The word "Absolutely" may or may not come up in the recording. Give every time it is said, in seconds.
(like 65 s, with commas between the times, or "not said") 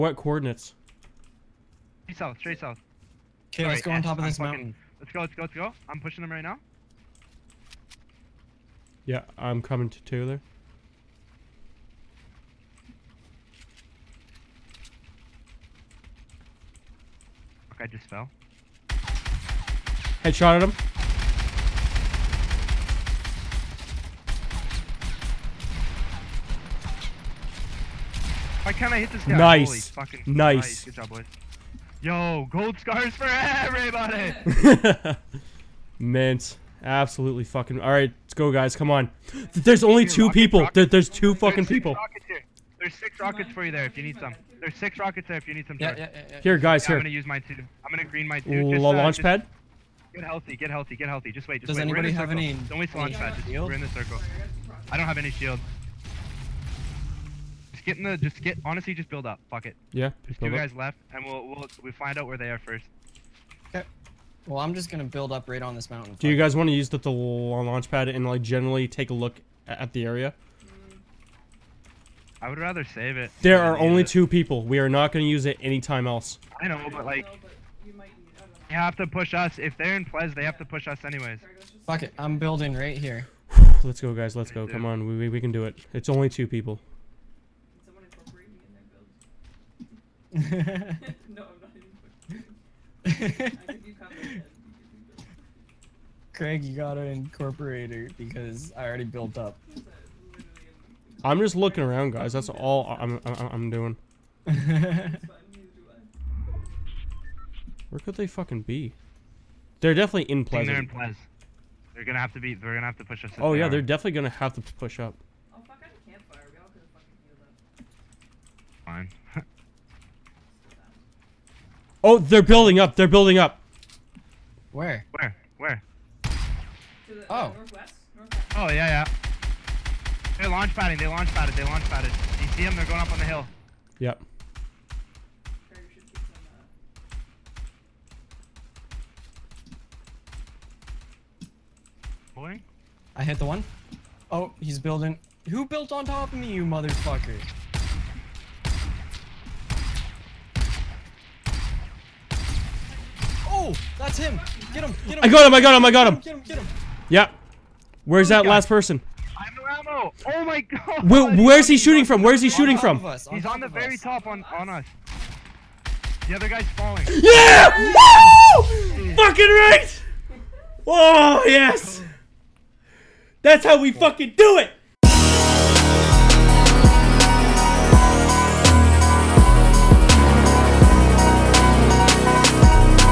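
36 s.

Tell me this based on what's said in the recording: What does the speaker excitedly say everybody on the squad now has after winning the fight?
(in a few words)
Gold scars.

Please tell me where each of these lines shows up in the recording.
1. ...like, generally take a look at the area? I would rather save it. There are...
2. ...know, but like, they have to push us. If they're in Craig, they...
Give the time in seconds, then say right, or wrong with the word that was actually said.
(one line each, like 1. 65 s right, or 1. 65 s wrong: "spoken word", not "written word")
1. 68 s right
2. 76 s wrong: "Plez", not "Craig".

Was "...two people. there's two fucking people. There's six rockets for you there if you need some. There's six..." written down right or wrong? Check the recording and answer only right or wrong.
right.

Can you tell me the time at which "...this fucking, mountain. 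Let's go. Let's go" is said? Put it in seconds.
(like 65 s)
4 s.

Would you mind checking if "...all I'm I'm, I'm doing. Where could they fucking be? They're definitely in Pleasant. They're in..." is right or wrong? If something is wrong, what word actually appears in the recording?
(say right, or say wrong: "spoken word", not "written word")
right.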